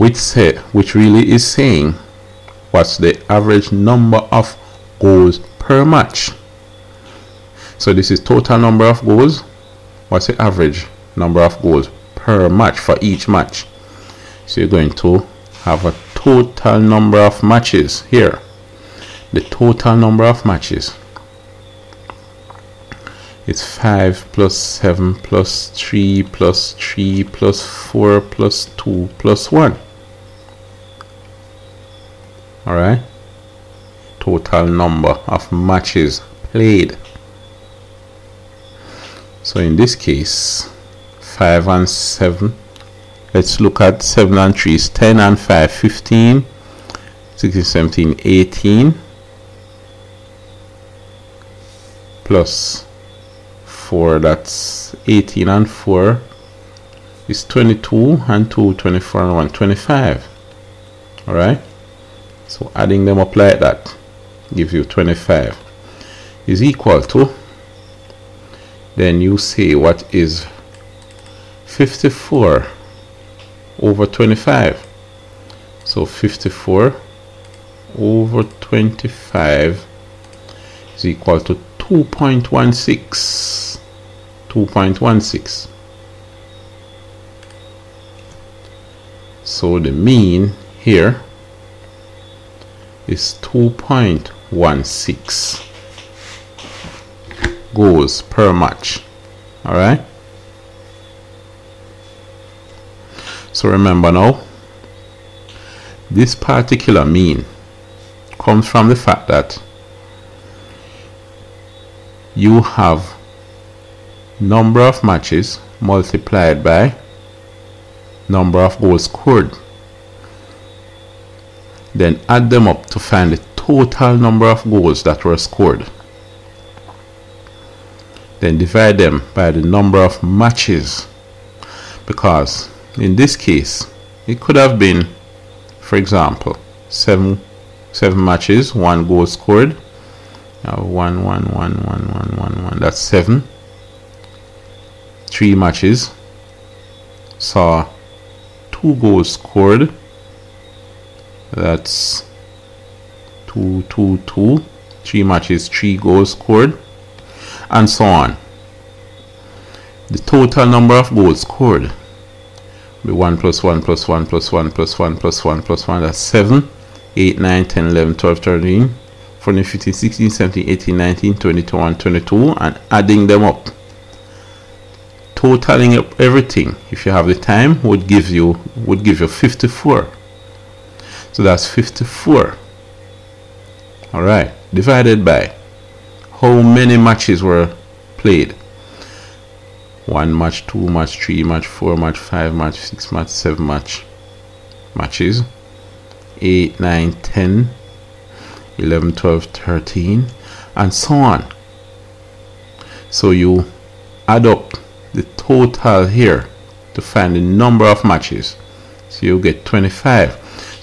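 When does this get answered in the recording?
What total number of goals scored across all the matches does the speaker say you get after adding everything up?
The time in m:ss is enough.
2:58.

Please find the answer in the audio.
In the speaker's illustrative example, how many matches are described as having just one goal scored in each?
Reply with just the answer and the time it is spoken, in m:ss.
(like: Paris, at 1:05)
7, at 2:16.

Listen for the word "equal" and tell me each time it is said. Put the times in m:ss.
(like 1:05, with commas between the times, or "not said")
1:06.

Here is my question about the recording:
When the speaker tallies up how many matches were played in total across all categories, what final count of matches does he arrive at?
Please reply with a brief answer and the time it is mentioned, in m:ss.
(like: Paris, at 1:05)
25, at 1:04.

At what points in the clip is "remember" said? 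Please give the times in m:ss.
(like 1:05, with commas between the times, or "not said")
1:43.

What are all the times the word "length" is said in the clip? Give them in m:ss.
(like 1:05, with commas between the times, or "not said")
not said.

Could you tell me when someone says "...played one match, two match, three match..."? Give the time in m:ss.
3:08.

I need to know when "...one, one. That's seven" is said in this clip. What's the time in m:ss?
2:22.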